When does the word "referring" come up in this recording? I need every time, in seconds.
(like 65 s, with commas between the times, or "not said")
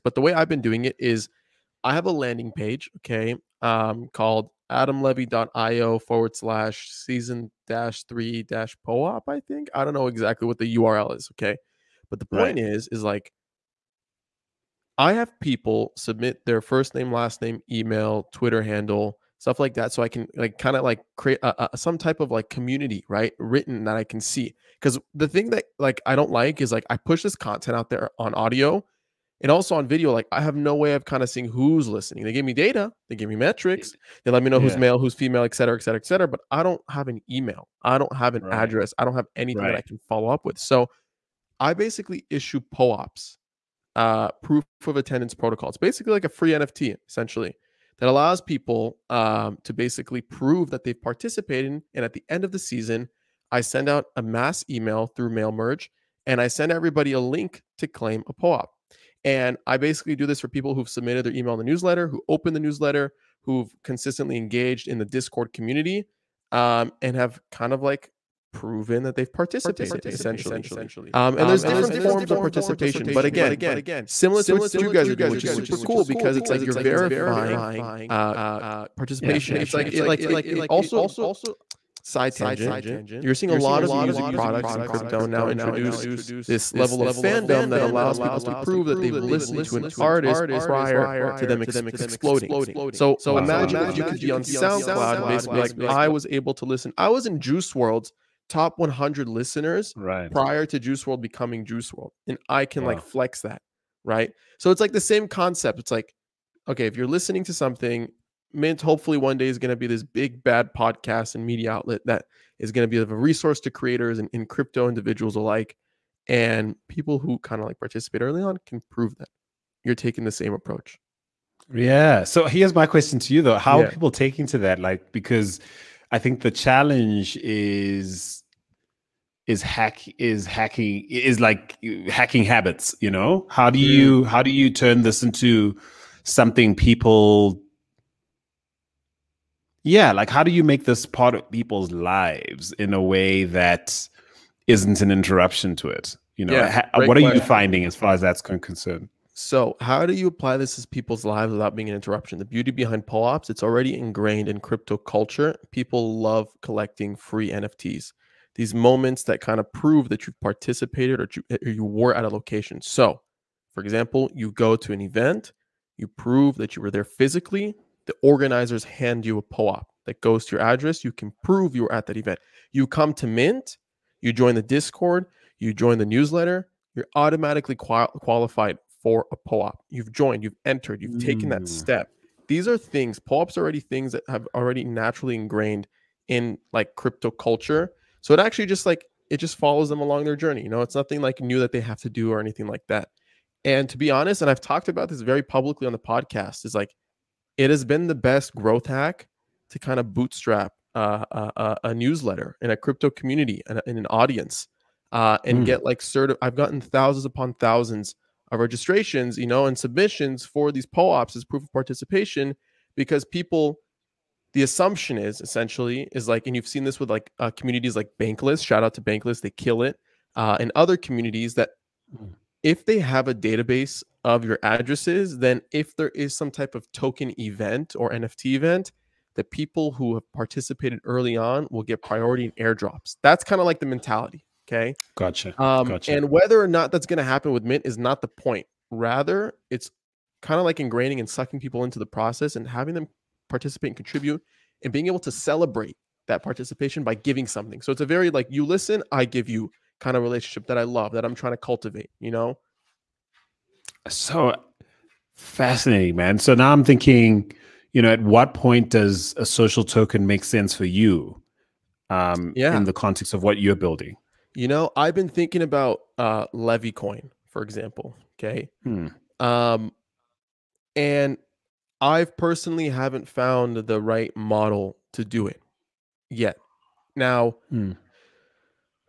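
not said.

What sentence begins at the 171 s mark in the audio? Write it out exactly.
You can prove you were at that event.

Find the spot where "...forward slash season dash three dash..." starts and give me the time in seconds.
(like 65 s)
6 s.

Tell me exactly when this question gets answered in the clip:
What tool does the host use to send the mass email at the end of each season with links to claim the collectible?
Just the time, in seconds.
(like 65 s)
55 s.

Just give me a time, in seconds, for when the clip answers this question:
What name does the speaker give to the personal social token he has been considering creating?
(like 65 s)
266 s.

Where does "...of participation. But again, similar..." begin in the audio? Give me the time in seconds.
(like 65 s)
72 s.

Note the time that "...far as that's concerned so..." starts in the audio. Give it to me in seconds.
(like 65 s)
147 s.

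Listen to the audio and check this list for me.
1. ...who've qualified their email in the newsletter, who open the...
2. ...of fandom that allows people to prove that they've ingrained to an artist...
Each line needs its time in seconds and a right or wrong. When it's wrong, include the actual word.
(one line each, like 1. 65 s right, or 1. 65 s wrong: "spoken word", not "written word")
1. 60 s wrong: "submitted", not "qualified"
2. 87 s wrong: "listened", not "ingrained".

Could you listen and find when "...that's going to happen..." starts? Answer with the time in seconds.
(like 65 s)
236 s.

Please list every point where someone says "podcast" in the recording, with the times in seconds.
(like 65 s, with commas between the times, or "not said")
110 s, 196 s.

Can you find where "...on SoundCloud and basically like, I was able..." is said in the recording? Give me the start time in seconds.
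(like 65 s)
94 s.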